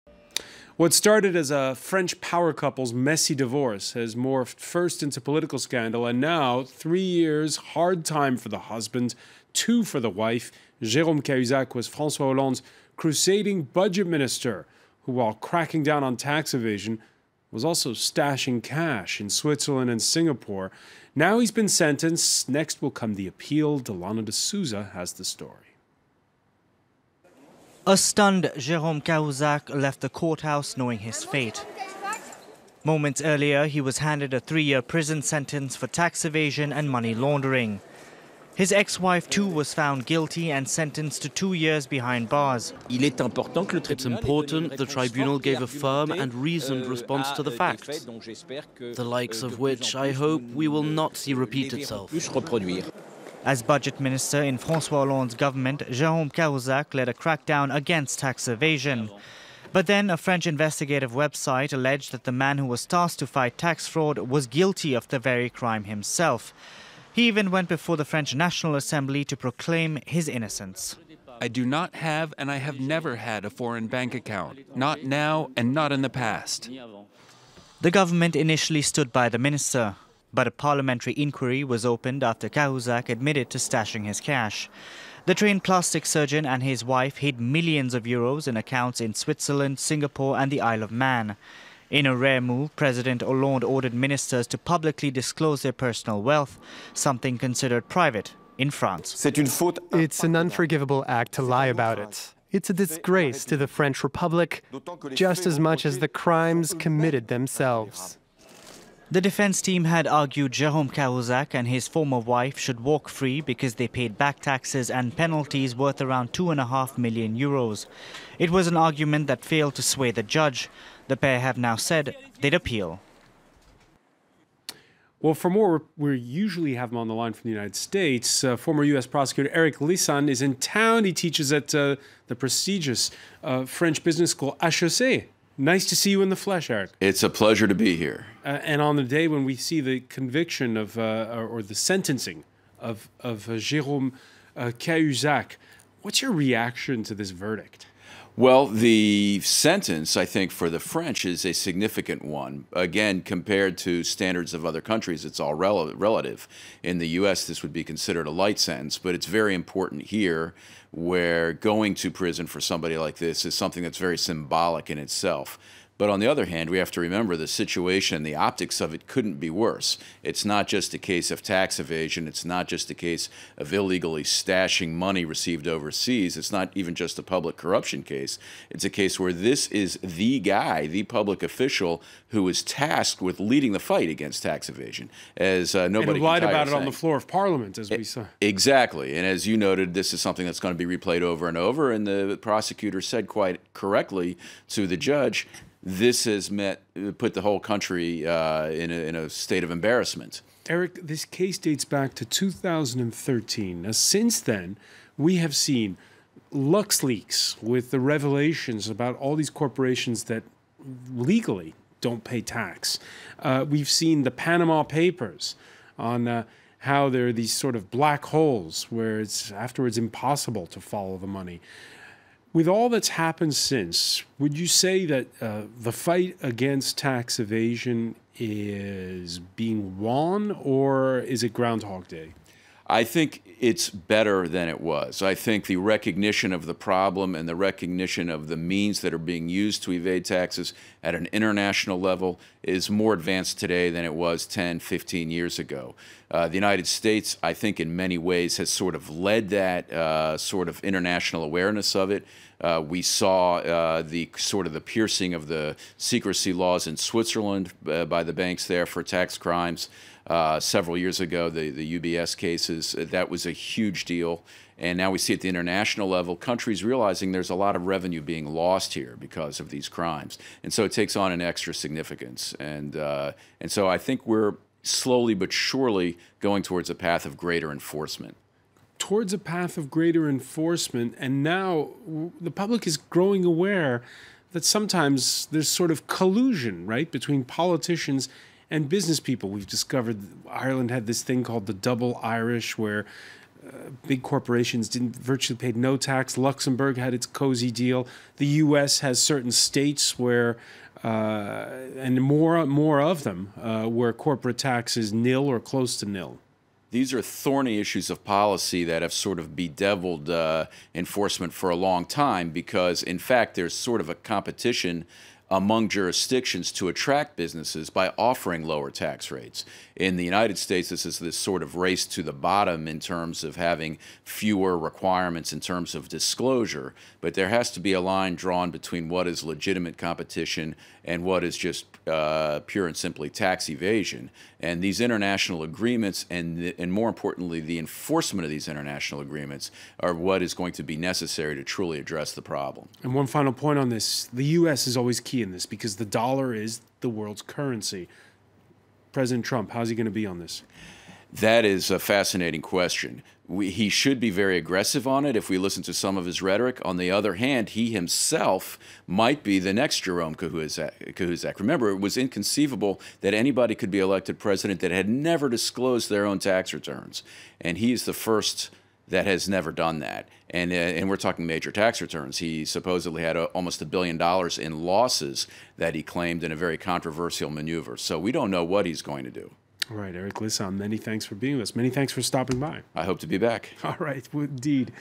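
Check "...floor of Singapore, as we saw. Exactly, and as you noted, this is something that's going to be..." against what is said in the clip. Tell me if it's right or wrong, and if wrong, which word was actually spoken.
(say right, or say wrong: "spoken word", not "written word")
wrong: "Parliament", not "Singapore".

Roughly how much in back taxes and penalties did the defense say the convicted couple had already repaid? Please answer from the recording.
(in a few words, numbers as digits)
2.5 million euros.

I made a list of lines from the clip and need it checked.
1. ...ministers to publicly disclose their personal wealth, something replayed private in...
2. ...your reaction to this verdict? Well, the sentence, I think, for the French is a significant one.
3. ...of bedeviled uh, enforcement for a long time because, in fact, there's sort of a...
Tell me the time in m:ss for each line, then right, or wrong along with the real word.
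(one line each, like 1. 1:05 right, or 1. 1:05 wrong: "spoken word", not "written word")
1. 1:33 wrong: "considered", not "replayed"
2. 2:26 right
3. 5:09 right.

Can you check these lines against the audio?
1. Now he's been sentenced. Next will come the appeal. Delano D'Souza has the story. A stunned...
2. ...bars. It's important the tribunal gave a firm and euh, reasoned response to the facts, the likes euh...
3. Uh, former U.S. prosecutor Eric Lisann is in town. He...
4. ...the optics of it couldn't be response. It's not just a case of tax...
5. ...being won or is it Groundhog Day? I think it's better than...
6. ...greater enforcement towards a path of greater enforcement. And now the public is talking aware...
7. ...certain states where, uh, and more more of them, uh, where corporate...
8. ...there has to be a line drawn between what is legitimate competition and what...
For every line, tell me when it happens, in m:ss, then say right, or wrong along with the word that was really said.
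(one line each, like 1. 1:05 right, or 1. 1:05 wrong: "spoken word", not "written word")
1. 0:21 right
2. 0:42 right
3. 2:08 right
4. 2:48 wrong: "worse", not "response"
5. 3:49 right
6. 4:37 wrong: "growing", not "talking"
7. 4:59 right
8. 5:27 right.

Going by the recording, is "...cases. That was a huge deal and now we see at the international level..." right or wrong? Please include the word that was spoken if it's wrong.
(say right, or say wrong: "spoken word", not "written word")
right.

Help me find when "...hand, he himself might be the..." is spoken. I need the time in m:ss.
5:57.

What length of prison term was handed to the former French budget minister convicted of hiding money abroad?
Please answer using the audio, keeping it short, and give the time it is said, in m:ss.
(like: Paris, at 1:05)
3 years, at 0:34.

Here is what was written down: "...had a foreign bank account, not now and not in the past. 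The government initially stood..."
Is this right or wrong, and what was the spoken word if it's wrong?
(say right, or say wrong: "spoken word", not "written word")
right.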